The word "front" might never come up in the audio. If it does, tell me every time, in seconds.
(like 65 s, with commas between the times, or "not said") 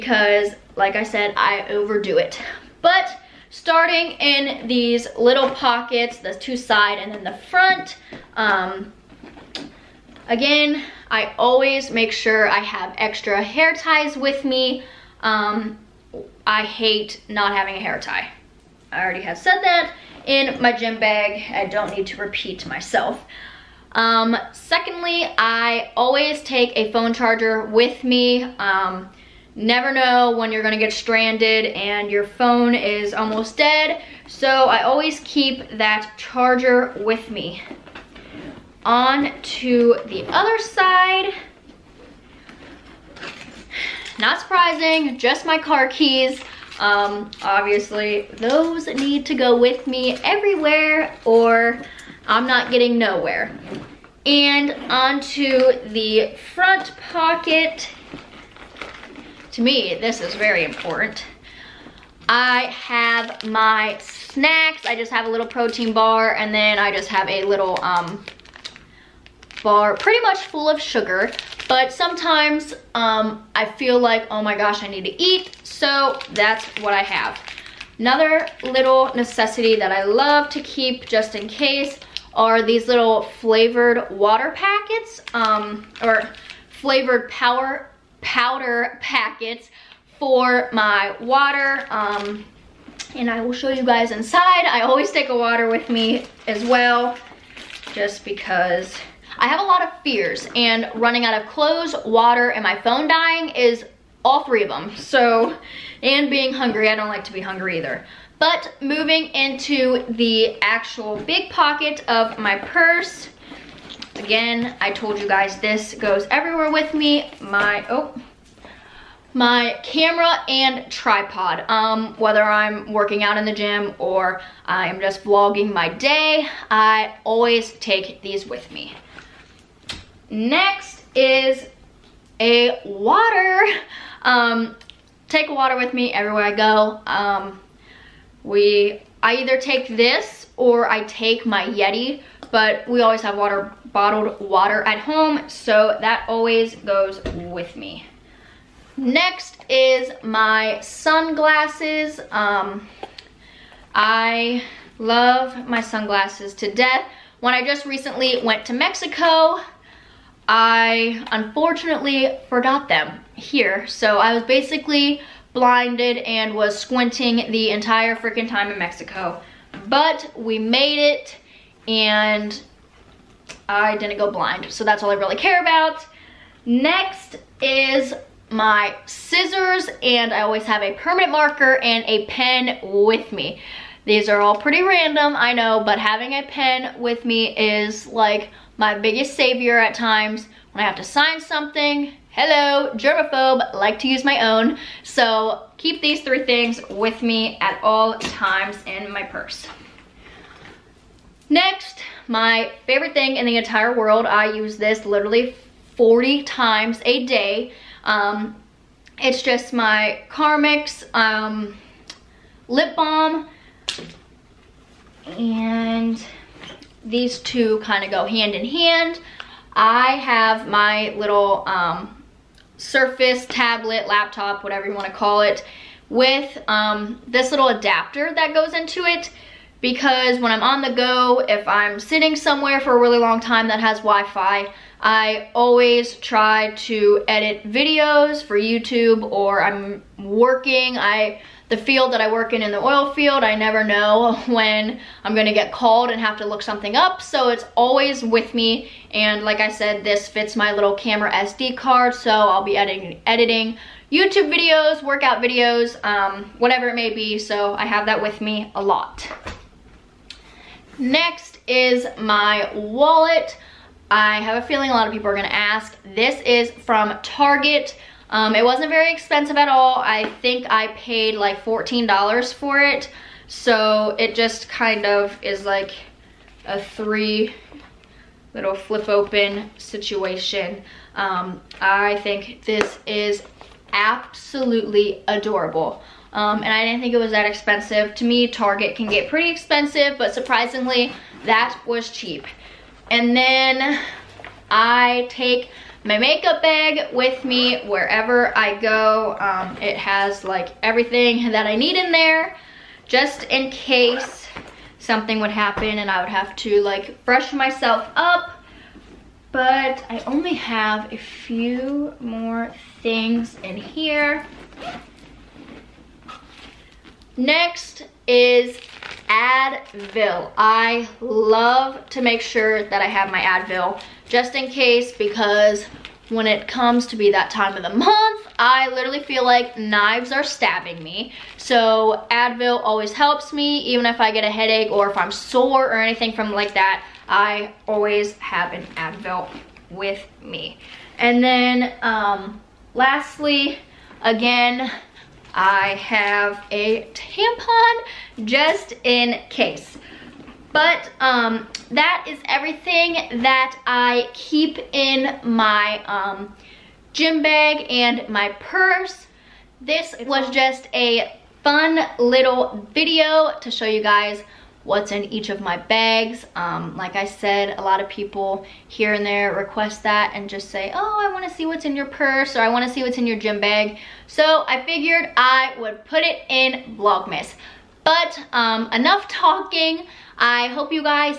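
7 s, 56 s.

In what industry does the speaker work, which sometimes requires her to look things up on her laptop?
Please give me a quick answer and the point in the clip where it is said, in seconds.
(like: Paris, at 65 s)
oil field, at 242 s.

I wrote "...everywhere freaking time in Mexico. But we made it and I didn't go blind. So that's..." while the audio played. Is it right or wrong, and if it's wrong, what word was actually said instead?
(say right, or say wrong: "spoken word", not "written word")
wrong: "entire", not "everywhere".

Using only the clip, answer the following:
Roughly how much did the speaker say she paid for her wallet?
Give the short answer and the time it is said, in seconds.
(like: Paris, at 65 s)
$14, at 271 s.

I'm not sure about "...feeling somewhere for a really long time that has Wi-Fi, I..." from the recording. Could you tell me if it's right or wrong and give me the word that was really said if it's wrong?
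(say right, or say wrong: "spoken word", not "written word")
wrong: "sitting", not "feeling".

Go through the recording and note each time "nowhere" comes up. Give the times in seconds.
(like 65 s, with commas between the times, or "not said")
52 s.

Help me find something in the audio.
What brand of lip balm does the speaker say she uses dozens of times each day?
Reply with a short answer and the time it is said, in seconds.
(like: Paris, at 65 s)
Carmex, at 210 s.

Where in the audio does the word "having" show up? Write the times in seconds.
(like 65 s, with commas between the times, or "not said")
17 s, 185 s.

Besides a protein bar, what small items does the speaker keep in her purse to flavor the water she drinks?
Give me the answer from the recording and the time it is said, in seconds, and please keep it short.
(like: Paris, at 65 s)
flavored power powder packets, at 86 s.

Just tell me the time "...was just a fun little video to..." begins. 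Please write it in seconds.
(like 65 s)
360 s.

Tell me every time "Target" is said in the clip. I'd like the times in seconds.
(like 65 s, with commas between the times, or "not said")
267 s, 288 s.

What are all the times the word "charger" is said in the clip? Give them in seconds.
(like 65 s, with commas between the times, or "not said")
27 s, 36 s.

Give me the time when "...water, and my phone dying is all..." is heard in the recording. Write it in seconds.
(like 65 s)
102 s.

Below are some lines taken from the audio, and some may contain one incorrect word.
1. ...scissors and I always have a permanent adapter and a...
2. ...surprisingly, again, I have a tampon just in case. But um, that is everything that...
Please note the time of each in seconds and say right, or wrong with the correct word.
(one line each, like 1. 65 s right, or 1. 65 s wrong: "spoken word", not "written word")
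1. 179 s wrong: "marker", not "adapter"
2. 342 s wrong: "lastly", not "surprisingly".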